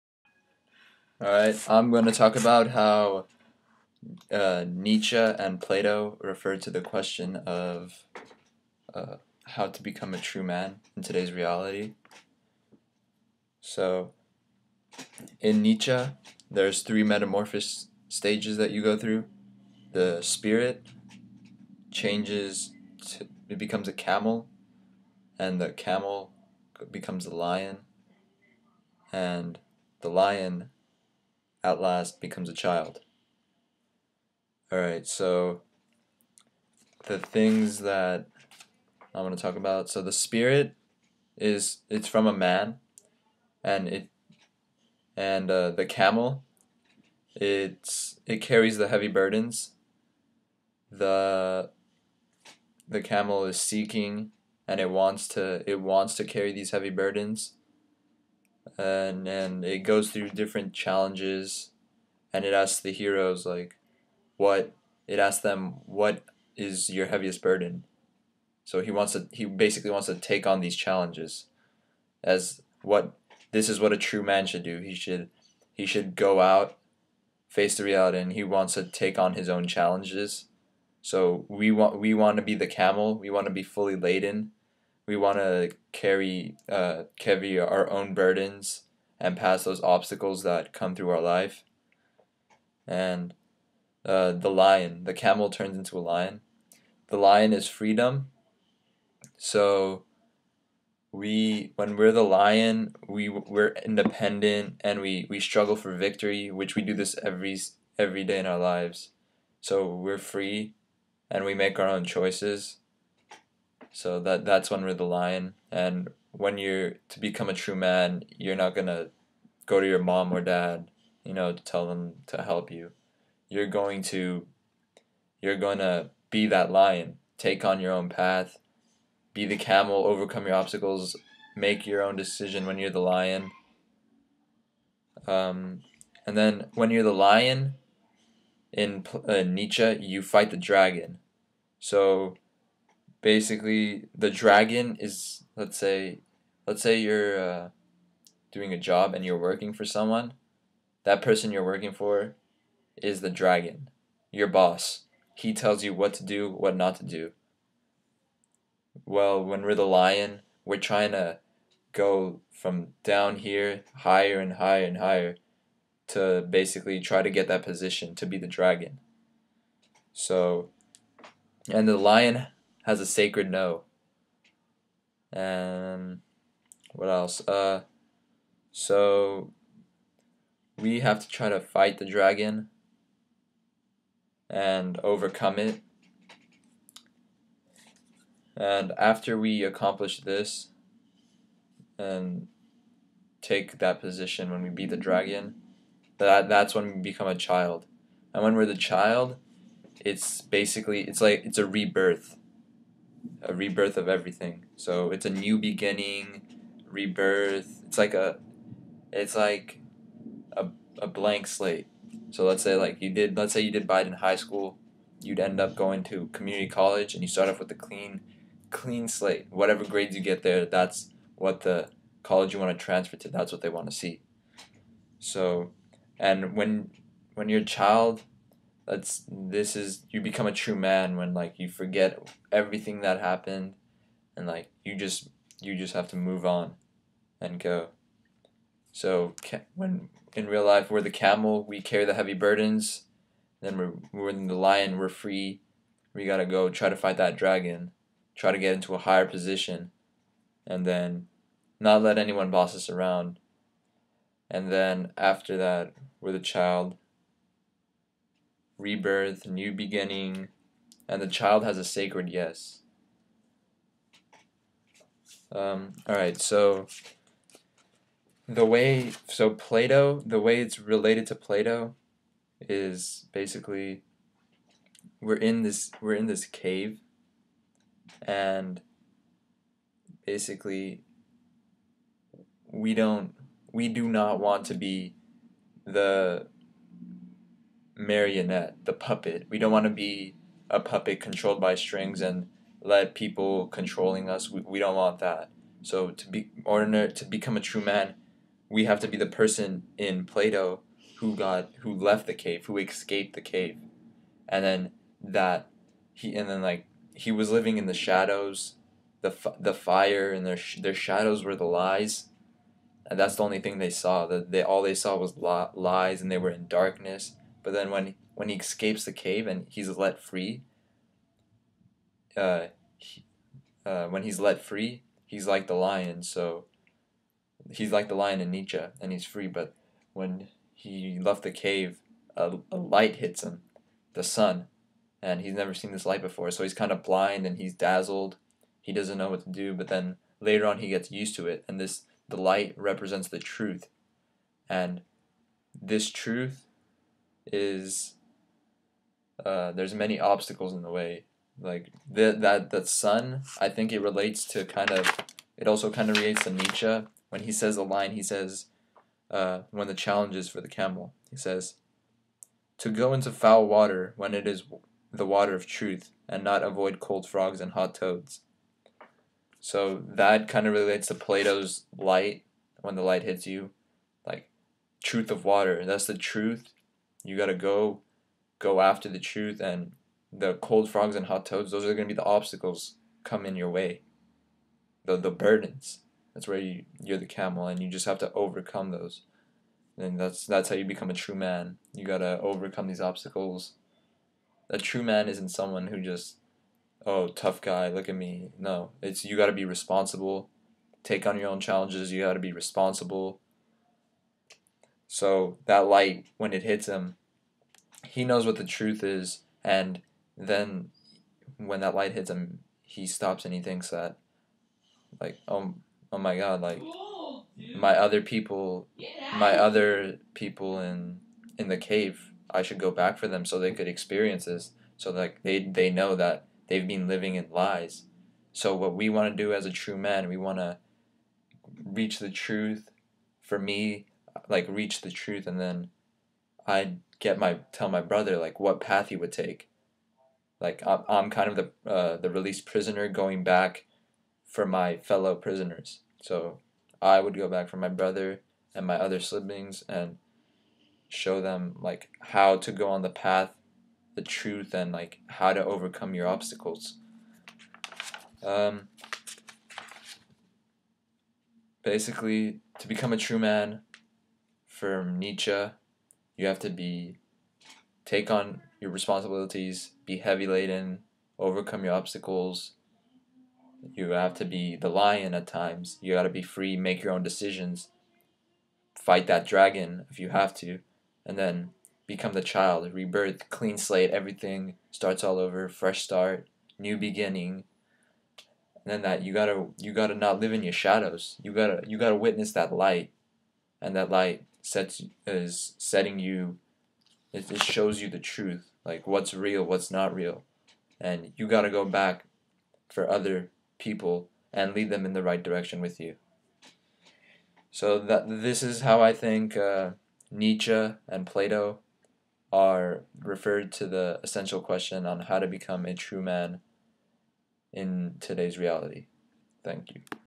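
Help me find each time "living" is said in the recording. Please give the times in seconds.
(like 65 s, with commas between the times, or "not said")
307 s, 427 s.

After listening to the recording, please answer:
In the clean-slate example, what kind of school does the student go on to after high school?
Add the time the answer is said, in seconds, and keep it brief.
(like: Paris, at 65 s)
Community college, at 216 s.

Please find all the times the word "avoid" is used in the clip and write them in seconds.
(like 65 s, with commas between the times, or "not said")
366 s.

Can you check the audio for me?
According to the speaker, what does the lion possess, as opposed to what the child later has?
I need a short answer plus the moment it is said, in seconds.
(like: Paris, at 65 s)
A sacred no, at 173 s.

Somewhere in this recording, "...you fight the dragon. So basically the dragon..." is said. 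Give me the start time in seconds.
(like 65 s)
140 s.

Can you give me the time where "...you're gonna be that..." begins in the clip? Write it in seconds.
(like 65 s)
125 s.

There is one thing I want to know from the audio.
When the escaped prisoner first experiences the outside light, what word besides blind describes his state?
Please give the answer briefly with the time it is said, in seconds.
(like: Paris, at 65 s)
Dazzled, at 337 s.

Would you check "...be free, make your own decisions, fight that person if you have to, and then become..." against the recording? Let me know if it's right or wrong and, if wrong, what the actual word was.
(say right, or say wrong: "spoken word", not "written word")
wrong: "dragon", not "person".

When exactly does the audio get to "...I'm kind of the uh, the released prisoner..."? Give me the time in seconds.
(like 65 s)
441 s.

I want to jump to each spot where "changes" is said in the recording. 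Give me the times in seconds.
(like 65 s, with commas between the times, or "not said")
21 s.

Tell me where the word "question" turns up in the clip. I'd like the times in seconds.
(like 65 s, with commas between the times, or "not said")
6 s, 514 s.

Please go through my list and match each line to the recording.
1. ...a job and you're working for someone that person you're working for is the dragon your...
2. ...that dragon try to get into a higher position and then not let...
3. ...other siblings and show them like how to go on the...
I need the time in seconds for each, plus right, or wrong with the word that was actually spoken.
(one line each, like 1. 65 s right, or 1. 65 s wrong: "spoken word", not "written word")
1. 148 s right
2. 247 s right
3. 448 s right.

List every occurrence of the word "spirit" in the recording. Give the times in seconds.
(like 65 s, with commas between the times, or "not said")
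20 s, 40 s.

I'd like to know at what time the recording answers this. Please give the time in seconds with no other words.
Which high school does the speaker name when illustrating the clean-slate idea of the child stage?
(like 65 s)
213 s.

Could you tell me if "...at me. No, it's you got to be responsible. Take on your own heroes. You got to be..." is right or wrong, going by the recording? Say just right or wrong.
wrong.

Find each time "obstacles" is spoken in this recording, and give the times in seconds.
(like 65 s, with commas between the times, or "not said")
89 s, 130 s, 350 s, 382 s, 393 s, 456 s, 471 s.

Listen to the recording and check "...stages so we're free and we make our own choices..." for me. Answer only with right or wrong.
wrong.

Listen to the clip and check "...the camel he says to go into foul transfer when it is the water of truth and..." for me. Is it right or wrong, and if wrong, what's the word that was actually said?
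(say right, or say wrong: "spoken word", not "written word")
wrong: "water", not "transfer".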